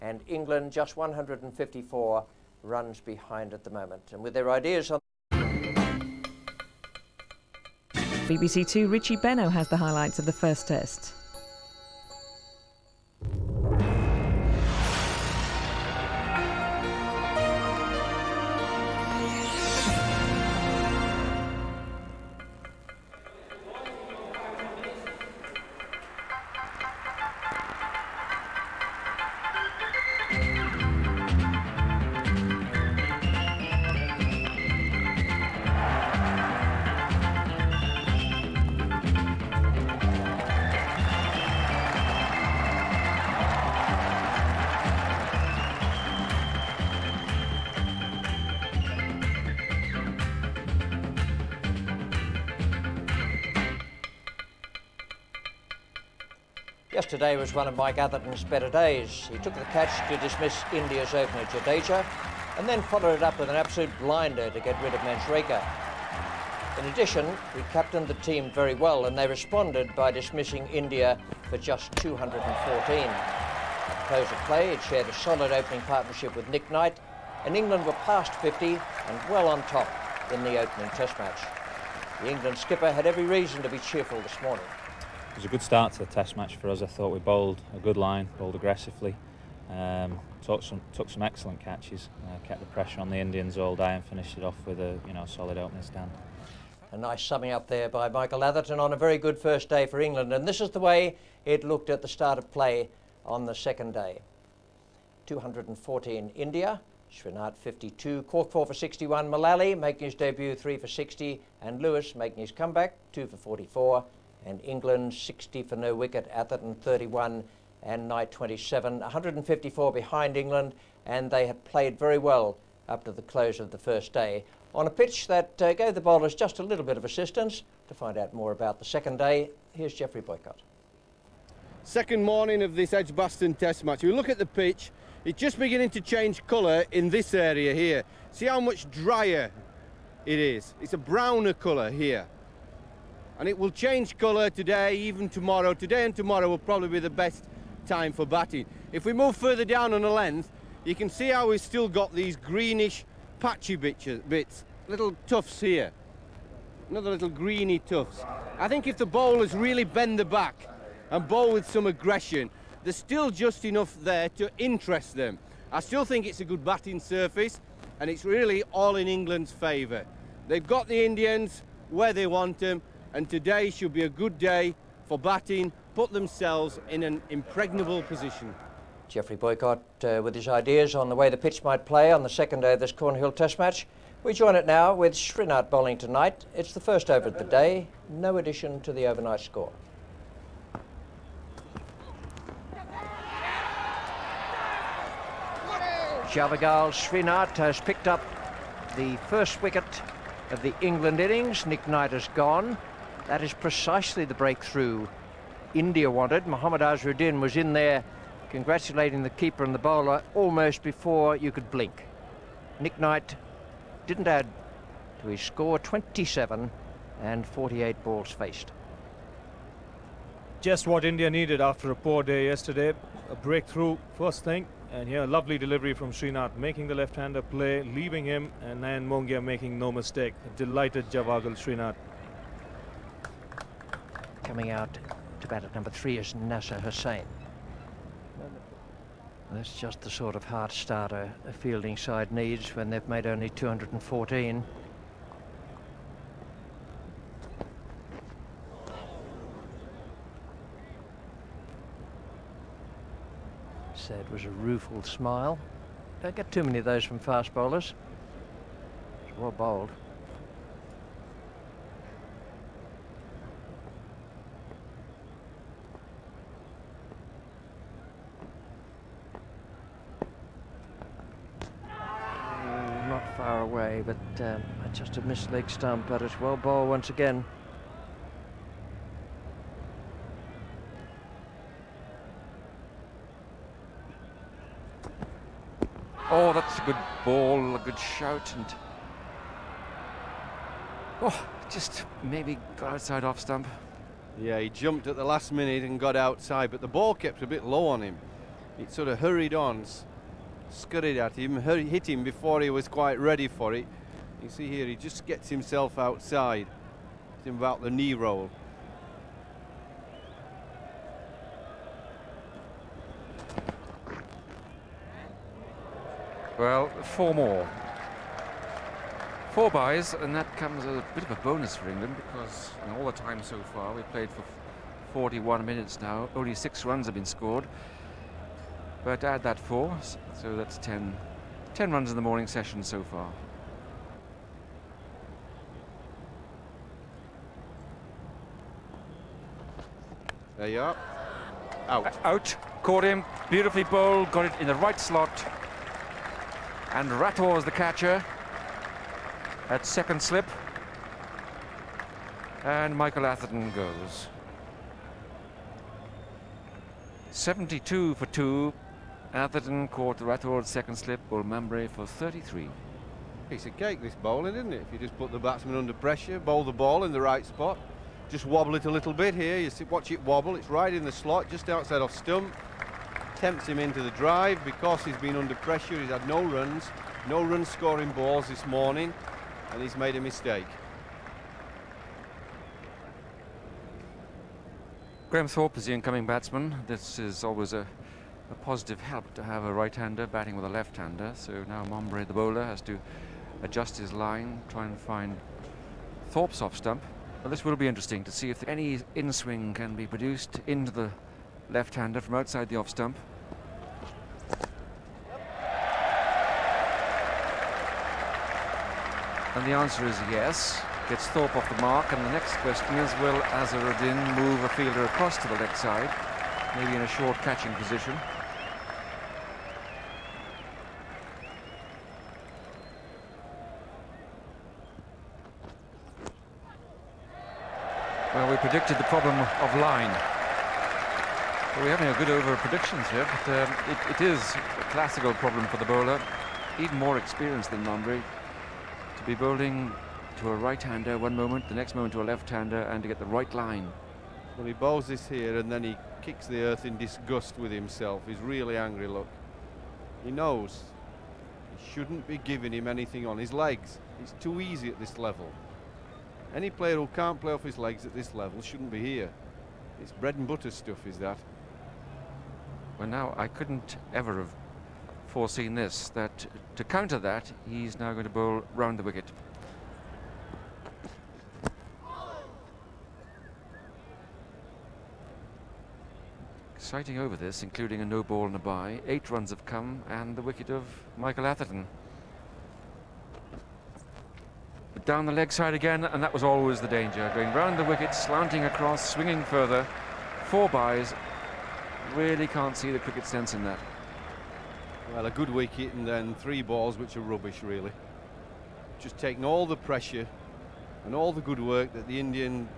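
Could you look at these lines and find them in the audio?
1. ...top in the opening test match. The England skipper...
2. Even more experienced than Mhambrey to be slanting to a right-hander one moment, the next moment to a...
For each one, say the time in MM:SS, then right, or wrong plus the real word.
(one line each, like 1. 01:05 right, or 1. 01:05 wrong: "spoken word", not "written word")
1. 01:19 right
2. 07:16 wrong: "bowling", not "slanting".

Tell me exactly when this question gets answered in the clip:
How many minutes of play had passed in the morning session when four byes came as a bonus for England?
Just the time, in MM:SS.
05:25.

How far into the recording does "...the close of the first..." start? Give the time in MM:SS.
02:03.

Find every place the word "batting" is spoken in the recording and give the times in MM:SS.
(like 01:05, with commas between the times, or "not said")
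02:28, 02:46, 02:55, 06:30.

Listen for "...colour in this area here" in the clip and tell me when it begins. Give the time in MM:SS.
02:16.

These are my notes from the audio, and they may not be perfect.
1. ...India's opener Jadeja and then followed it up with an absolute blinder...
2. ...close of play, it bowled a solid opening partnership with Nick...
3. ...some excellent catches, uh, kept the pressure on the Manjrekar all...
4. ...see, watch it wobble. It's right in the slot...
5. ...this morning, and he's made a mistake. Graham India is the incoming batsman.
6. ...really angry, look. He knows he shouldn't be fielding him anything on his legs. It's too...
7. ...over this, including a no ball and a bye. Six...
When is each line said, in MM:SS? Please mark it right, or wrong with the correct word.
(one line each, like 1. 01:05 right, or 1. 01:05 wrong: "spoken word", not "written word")
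1. 01:00 right
2. 01:14 wrong: "shared", not "bowled"
3. 01:31 wrong: "Indians", not "Manjrekar"
4. 06:09 right
5. 06:18 wrong: "Thorpe", not "India"
6. 07:28 wrong: "giving", not "fielding"
7. 07:57 wrong: "Eight", not "Six".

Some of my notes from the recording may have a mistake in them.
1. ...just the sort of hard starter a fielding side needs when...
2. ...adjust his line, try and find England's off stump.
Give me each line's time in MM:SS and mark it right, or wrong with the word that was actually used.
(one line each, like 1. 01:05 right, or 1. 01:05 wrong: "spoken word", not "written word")
1. 03:59 right
2. 06:33 wrong: "Thorpe", not "England".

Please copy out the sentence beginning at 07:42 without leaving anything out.
Well, now, I couldn't ever have foreseen this, that to counter that, he's now going to bowl round the wicket.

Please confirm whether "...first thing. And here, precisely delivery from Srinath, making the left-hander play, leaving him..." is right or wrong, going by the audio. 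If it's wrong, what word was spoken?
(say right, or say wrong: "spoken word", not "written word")
wrong: "lovely", not "precisely".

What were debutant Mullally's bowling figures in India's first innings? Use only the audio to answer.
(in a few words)
3 for 60.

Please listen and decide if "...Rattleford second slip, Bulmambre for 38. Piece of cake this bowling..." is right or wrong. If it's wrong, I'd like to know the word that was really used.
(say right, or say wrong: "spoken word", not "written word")
wrong: "33", not "38".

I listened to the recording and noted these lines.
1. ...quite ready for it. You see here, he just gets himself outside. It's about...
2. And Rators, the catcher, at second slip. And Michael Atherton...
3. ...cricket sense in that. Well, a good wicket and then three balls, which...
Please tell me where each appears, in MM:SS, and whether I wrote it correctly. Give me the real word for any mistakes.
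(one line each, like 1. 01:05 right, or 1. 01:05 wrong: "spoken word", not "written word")
1. 05:02 right
2. 05:46 right
3. 08:12 right.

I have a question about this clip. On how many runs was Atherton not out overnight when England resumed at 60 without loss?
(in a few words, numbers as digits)
31.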